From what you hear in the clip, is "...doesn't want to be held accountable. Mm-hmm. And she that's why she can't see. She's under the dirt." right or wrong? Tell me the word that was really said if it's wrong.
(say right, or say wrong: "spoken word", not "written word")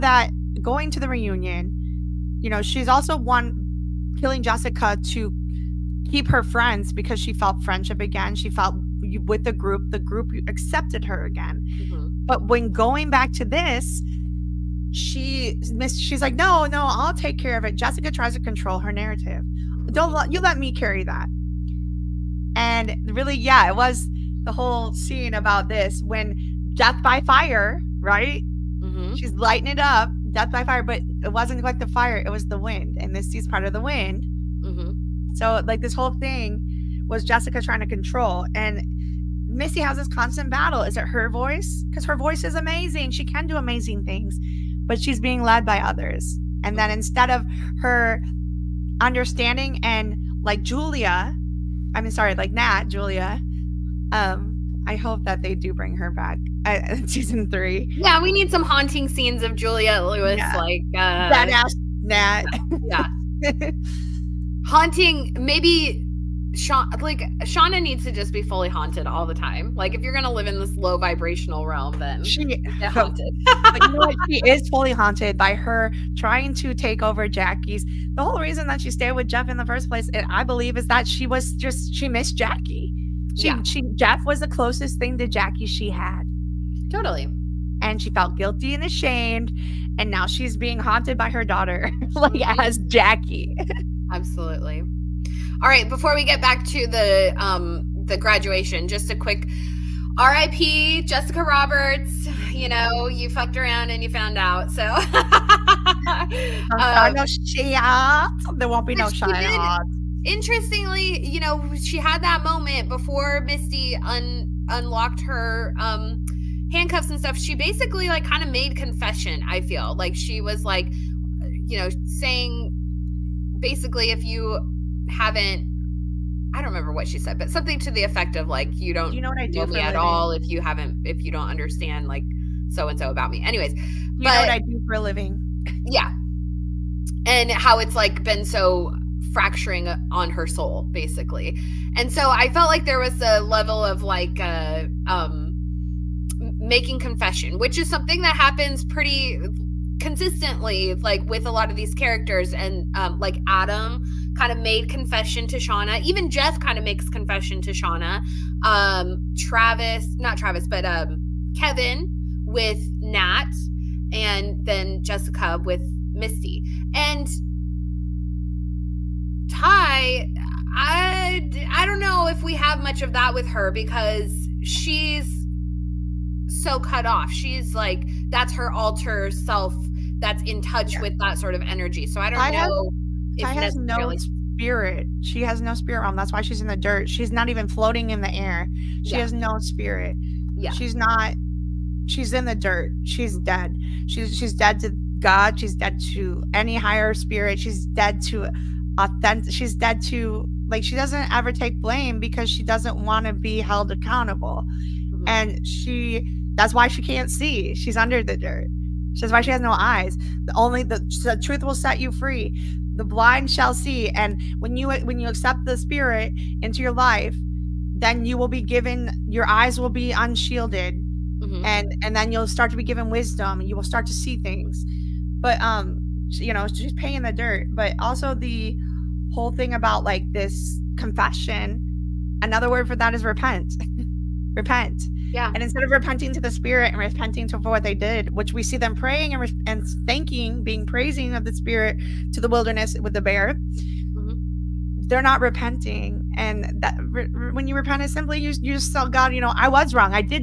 right.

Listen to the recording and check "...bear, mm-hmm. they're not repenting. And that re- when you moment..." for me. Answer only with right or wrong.
wrong.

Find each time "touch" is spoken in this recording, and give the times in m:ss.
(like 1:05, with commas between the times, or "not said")
3:00.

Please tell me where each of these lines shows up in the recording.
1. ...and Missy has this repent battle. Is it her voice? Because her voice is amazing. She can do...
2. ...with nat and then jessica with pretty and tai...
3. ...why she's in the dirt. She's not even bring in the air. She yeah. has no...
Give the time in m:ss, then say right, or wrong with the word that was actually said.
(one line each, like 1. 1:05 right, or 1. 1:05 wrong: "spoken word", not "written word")
1. 0:38 wrong: "constant", not "repent"
2. 2:42 wrong: "misty", not "pretty"
3. 3:06 wrong: "floating", not "bring".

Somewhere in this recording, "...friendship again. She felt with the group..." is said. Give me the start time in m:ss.
0:07.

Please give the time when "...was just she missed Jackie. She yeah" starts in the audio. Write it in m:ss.
1:21.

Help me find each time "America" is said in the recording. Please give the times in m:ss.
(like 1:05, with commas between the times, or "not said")
not said.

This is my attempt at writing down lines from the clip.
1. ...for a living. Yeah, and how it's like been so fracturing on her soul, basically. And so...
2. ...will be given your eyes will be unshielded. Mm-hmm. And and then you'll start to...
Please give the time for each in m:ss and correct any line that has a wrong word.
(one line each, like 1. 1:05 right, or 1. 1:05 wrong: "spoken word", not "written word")
1. 2:14 right
2. 3:38 right.